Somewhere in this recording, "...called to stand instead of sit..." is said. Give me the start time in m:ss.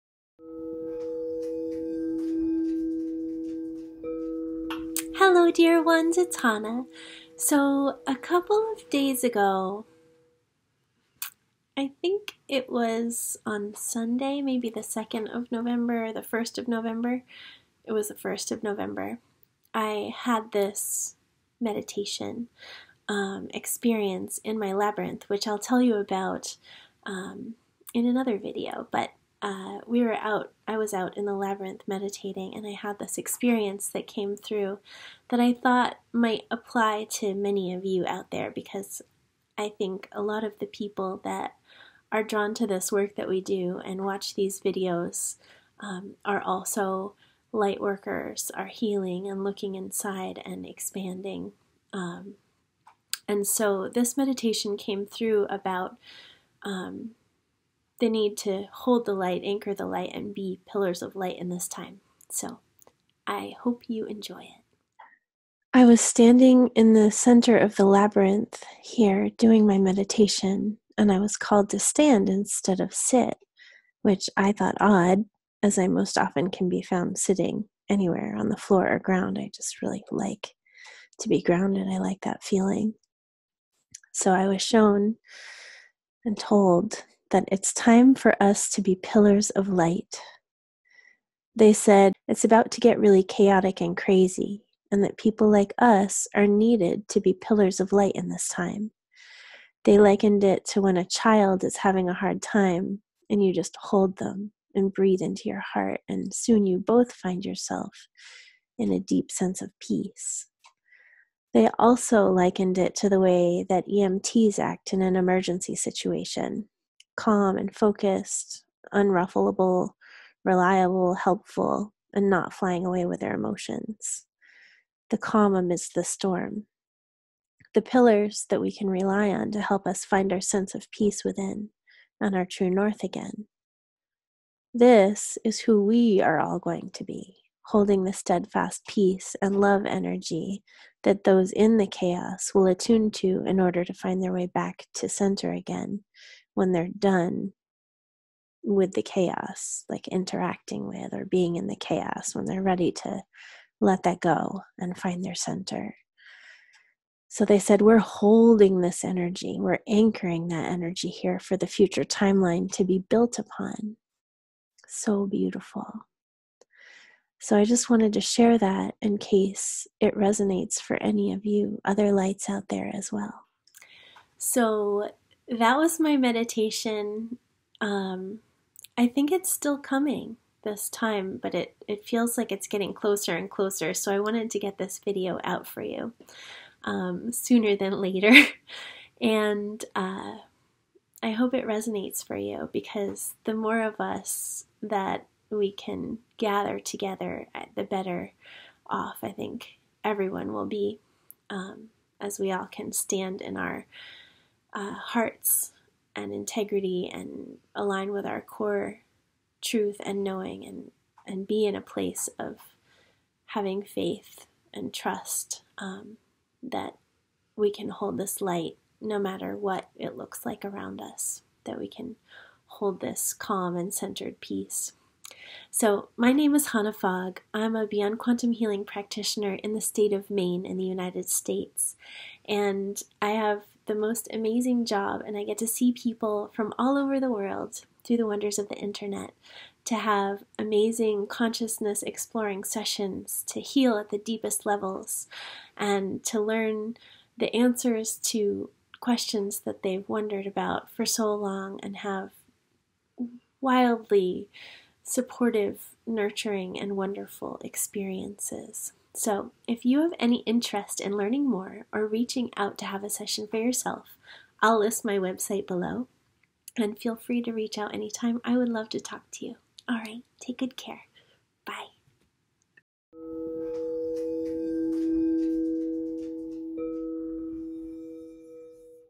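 1:11.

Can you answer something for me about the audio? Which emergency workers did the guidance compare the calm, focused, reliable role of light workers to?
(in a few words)
EMTs.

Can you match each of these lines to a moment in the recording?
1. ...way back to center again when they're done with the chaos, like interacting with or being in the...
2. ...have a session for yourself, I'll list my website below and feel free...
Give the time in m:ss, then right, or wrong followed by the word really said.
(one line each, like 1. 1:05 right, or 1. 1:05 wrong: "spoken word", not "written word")
1. 2:24 right
2. 4:22 right.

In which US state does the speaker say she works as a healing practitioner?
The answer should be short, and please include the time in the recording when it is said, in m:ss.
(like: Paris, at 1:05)
Maine, at 3:50.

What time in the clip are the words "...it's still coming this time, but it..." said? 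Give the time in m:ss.
2:59.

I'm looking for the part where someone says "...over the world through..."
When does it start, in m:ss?
3:56.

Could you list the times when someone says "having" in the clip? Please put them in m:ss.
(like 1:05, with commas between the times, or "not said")
1:41, 3:33.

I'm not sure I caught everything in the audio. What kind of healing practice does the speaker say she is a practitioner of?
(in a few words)
Beyond Quantum Healing.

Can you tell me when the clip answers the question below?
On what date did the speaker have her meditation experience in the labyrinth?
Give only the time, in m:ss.
0:17.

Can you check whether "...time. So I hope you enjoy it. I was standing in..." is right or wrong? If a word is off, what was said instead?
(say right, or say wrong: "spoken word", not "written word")
right.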